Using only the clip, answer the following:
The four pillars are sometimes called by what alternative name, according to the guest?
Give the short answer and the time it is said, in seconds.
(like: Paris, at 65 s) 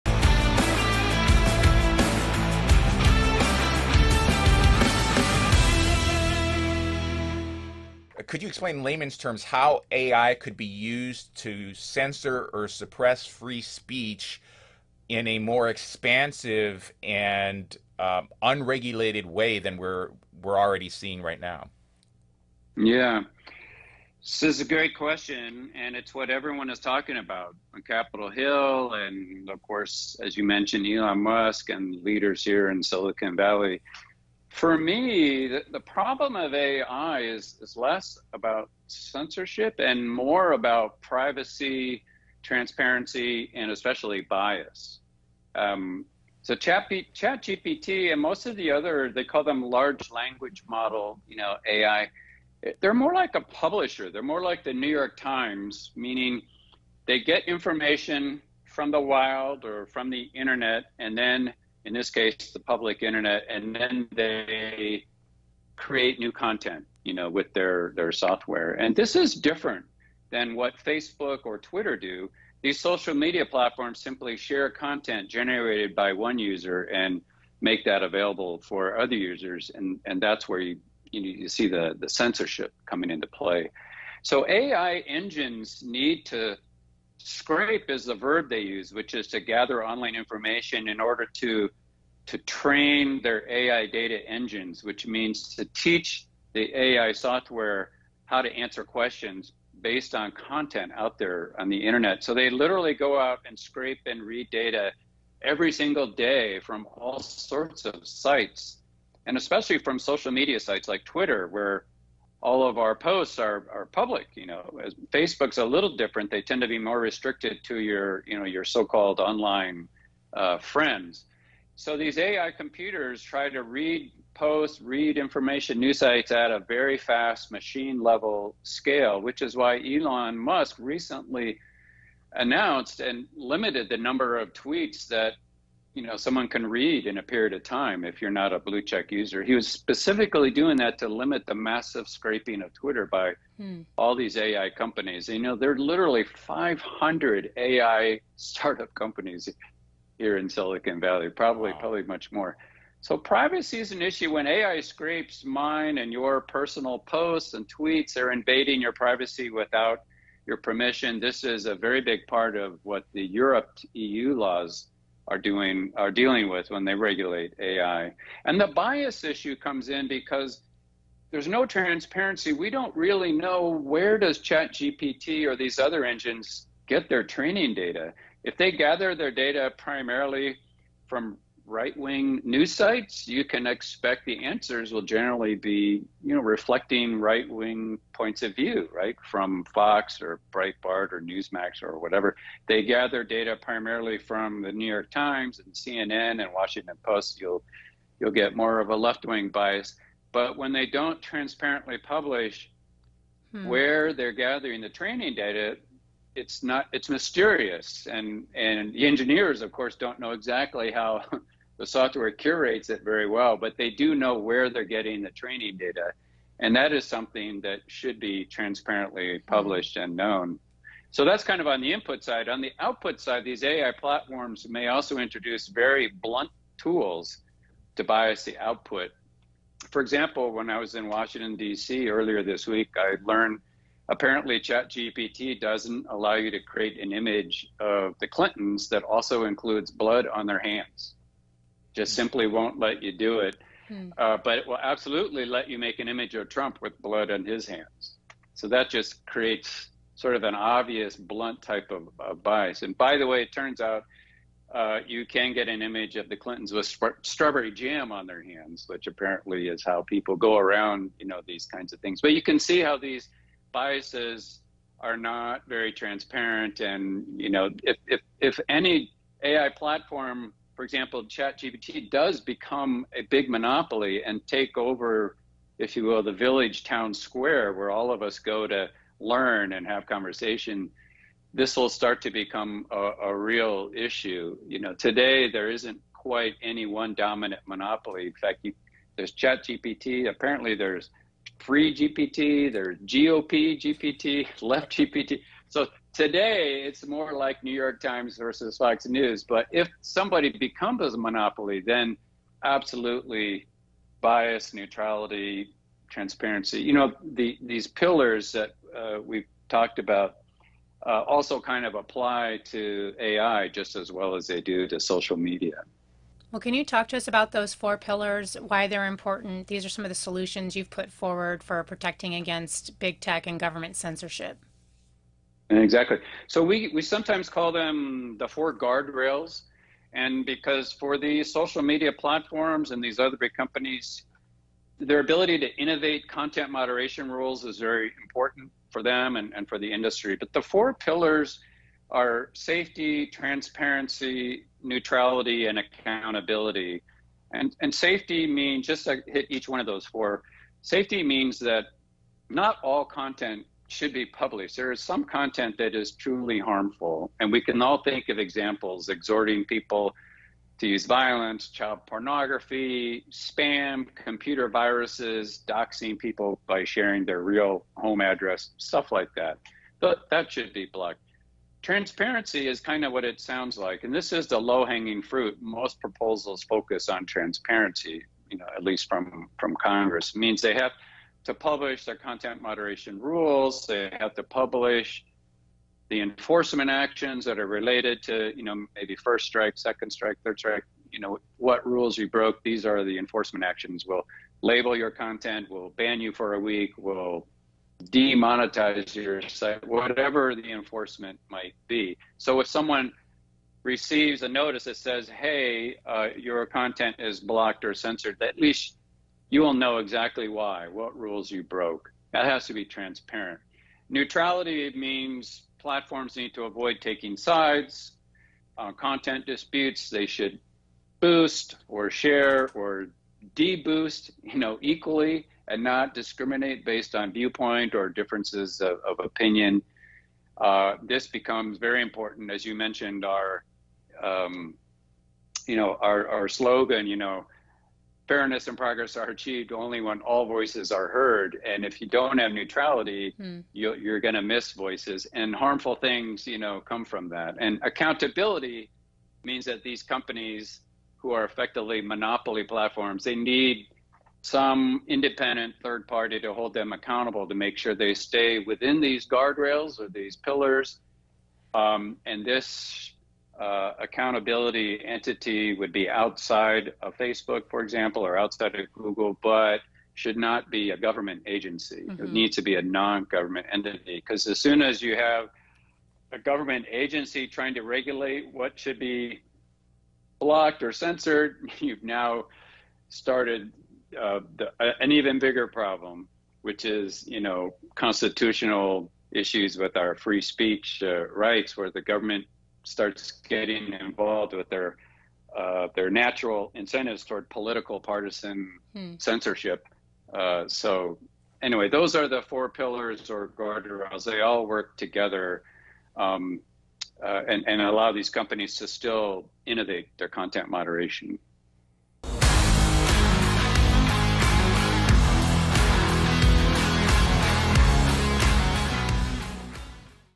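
four guardrails, at 328 s.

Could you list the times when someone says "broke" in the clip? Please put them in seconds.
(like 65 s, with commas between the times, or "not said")
392 s, 411 s.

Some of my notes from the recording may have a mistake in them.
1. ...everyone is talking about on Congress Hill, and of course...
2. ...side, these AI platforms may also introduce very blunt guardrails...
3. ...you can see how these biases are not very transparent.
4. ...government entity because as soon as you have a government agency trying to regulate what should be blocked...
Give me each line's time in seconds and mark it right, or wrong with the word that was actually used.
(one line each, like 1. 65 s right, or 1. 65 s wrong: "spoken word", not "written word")
1. 26 s wrong: "Capitol", not "Congress"
2. 223 s wrong: "tools", not "guardrails"
3. 262 s right
4. 473 s right.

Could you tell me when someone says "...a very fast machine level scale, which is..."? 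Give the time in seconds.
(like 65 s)
126 s.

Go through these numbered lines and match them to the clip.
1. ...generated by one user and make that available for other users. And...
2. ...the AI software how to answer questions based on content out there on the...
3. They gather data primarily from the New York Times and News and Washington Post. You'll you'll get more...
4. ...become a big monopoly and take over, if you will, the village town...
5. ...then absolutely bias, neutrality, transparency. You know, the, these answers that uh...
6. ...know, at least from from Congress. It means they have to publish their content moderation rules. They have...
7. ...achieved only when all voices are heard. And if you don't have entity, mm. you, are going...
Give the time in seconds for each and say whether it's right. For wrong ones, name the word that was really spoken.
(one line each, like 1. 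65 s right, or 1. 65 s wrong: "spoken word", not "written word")
1. 75 s right
2. 96 s right
3. 192 s wrong: "CNN", not "News"
4. 272 s right
5. 301 s wrong: "pillars", not "answers"
6. 378 s right
7. 439 s wrong: "neutrality", not "entity".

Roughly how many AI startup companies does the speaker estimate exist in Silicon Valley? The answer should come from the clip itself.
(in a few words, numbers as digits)
500.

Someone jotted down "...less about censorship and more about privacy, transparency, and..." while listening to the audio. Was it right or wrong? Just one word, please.
right.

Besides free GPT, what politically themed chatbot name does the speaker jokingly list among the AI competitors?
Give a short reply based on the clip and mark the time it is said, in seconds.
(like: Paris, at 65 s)
GOP GPT, at 293 s.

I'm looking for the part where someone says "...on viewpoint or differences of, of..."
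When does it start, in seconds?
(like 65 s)
427 s.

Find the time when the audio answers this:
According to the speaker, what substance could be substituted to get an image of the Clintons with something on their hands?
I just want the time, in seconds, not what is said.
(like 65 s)
257 s.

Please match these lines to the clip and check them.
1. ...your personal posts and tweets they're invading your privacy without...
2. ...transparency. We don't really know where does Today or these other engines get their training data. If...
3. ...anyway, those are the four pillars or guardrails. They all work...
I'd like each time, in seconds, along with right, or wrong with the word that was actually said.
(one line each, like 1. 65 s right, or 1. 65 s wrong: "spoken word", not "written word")
1. 156 s right
2. 171 s wrong: "ChatGPT", not "Today"
3. 501 s right.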